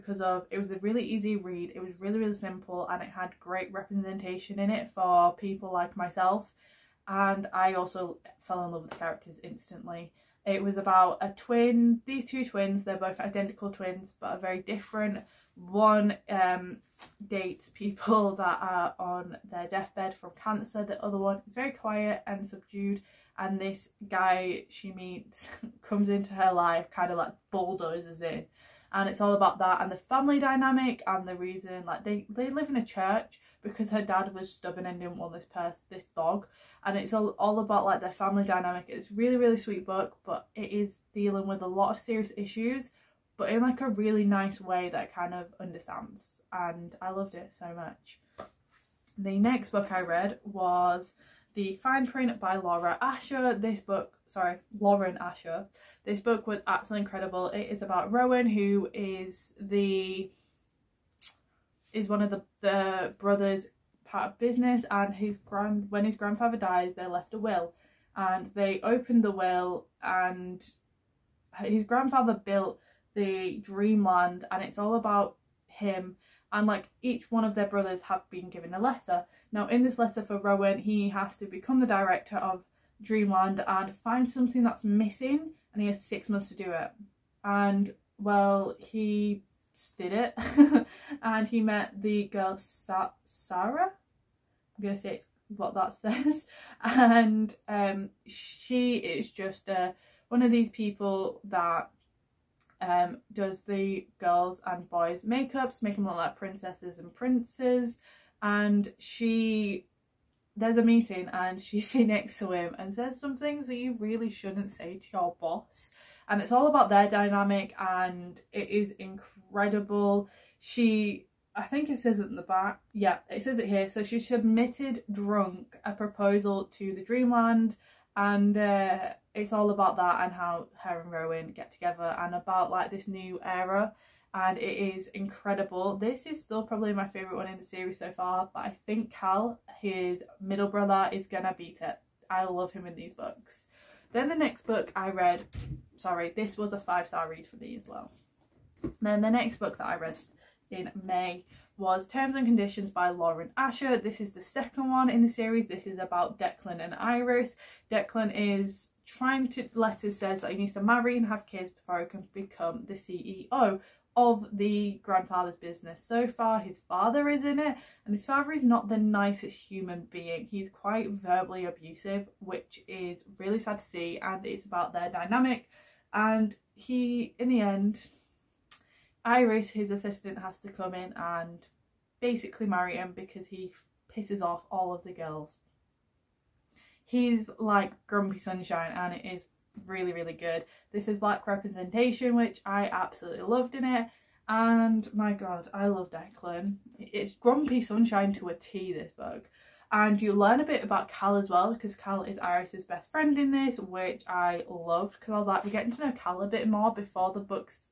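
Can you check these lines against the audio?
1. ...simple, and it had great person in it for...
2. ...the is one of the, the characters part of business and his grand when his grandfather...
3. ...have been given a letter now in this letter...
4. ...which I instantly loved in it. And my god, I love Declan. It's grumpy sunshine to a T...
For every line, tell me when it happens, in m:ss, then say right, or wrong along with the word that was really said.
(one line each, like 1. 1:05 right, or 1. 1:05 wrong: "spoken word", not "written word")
1. 0:02 wrong: "representation", not "person"
2. 0:59 wrong: "brothers", not "characters"
3. 1:18 right
4. 3:12 wrong: "absolutely", not "instantly".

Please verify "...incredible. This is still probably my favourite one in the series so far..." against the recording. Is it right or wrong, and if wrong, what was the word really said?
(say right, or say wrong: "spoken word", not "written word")
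right.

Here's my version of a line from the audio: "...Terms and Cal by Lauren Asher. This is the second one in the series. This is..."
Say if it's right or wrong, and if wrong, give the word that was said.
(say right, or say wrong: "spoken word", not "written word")
wrong: "Conditions", not "Cal".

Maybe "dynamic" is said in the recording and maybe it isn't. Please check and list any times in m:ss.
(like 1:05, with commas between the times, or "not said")
0:30, 0:38, 1:57, 2:55.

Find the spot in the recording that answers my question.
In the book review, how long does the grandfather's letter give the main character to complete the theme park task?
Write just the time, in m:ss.
1:26.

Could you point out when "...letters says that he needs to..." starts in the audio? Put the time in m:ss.
2:39.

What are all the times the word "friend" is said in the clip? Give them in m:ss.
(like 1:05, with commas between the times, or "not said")
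3:23.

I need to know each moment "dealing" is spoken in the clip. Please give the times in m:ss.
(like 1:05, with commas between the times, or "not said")
0:41.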